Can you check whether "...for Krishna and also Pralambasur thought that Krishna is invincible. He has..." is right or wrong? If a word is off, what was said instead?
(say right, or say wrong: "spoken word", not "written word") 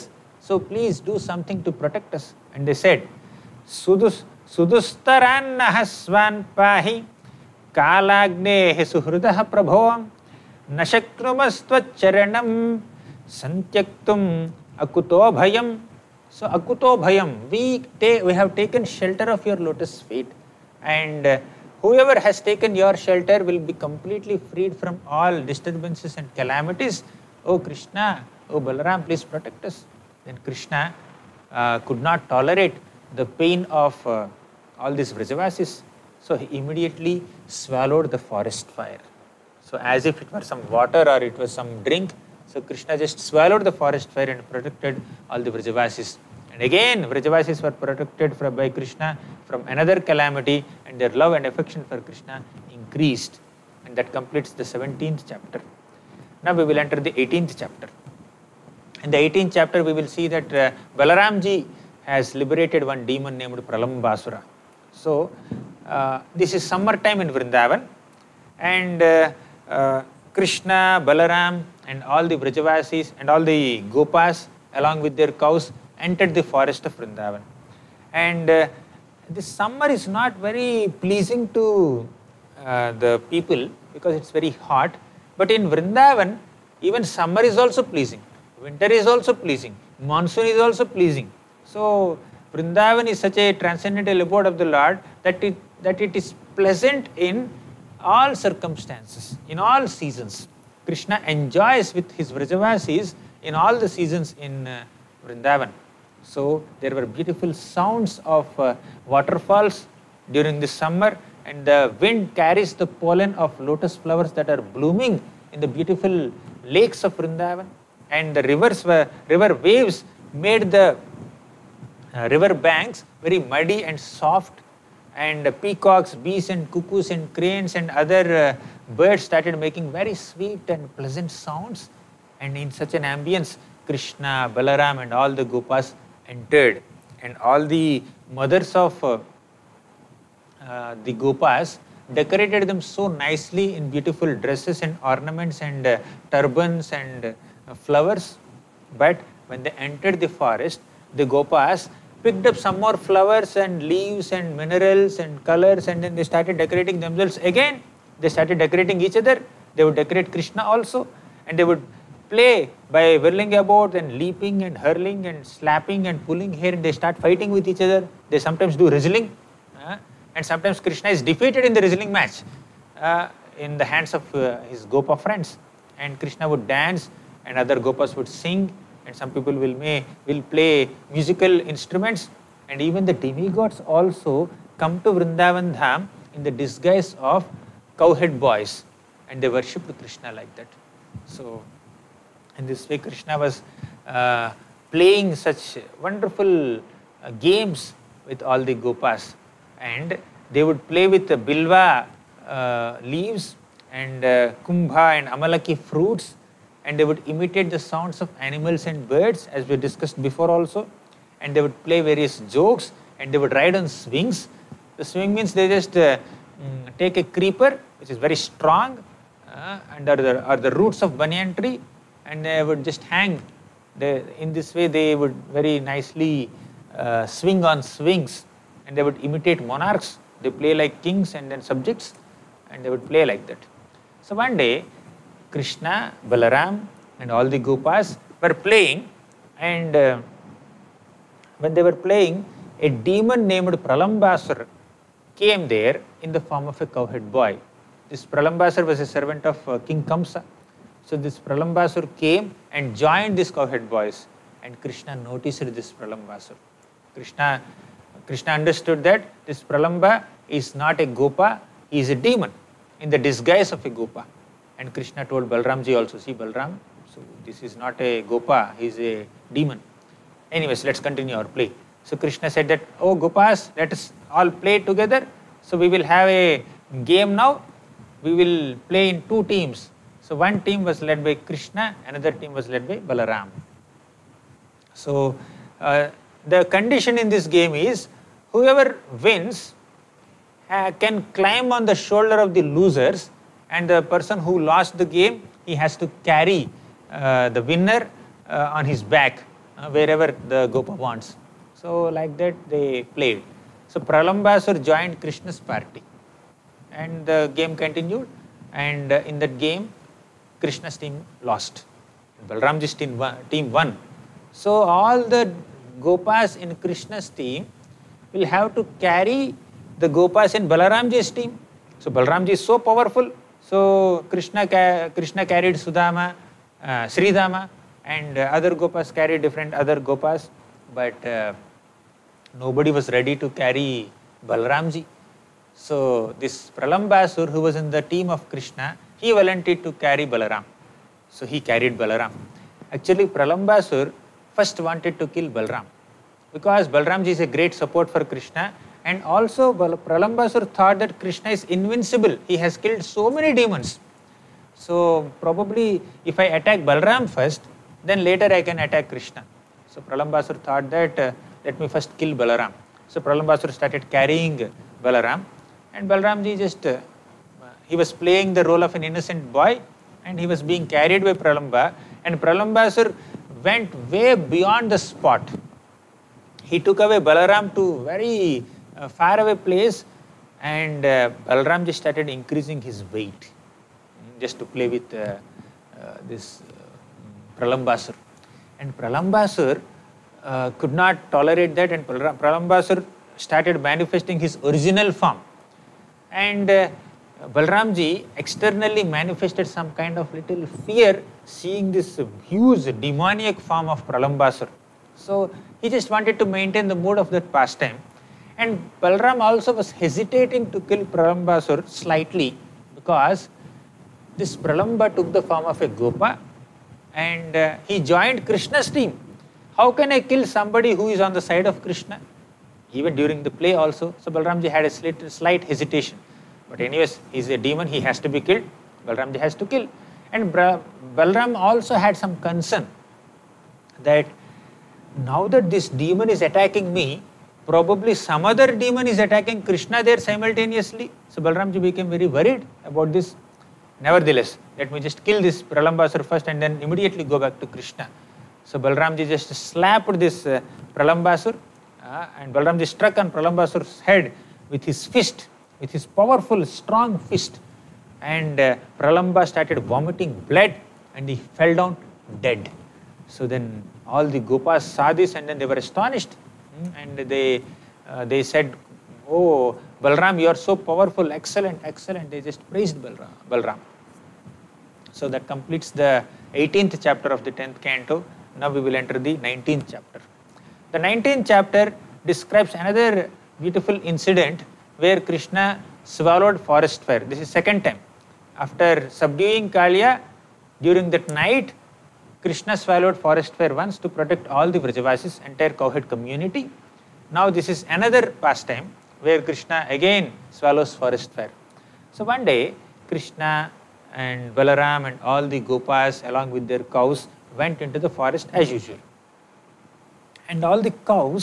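right.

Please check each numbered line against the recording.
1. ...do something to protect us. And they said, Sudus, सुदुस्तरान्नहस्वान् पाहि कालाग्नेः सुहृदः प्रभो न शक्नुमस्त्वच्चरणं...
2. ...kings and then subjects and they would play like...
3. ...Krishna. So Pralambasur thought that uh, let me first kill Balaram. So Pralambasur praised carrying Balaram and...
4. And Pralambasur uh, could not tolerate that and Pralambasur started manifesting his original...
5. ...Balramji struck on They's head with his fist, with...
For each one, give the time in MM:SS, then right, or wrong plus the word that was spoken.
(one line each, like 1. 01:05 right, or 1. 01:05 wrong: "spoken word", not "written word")
1. 00:00 right
2. 03:51 right
3. 05:59 wrong: "started", not "praised"
4. 06:28 right
5. 07:32 wrong: "Pralambasur", not "They".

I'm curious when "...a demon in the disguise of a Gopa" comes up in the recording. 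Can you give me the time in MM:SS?
04:22.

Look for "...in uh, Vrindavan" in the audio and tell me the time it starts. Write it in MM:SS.
01:44.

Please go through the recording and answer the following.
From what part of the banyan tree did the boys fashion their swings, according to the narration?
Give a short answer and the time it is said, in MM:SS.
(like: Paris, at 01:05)
The roots, at 03:40.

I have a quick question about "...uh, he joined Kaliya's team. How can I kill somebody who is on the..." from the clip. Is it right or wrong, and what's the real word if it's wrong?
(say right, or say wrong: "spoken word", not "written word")
wrong: "Krishna", not "Kaliya".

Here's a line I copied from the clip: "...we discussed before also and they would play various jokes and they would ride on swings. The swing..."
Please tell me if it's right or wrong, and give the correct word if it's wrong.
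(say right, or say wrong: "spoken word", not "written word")
right.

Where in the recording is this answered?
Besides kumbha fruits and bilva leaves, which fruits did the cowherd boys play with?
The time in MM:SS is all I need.
03:25.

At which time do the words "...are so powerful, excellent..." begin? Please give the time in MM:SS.
07:50.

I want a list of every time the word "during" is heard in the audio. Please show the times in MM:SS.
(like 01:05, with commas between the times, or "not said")
01:50, 07:03, 08:10.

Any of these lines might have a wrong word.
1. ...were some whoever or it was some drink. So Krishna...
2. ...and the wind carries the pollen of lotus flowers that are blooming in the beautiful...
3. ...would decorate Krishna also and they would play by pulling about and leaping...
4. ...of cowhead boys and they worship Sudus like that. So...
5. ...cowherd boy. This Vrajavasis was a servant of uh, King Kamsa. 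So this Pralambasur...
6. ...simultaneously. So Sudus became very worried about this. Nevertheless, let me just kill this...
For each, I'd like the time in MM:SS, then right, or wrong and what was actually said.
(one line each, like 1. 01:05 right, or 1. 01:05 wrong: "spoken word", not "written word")
1. 00:40 wrong: "water", not "whoever"
2. 01:51 right
3. 02:39 wrong: "whirling", not "pulling"
4. 03:07 wrong: "Krishna", not "Sudus"
5. 04:06 wrong: "Pralambasur", not "Vrajavasis"
6. 07:20 wrong: "Balramji", not "Sudus".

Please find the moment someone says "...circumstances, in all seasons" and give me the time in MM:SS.
01:38.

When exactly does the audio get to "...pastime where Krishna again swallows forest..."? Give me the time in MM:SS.
08:18.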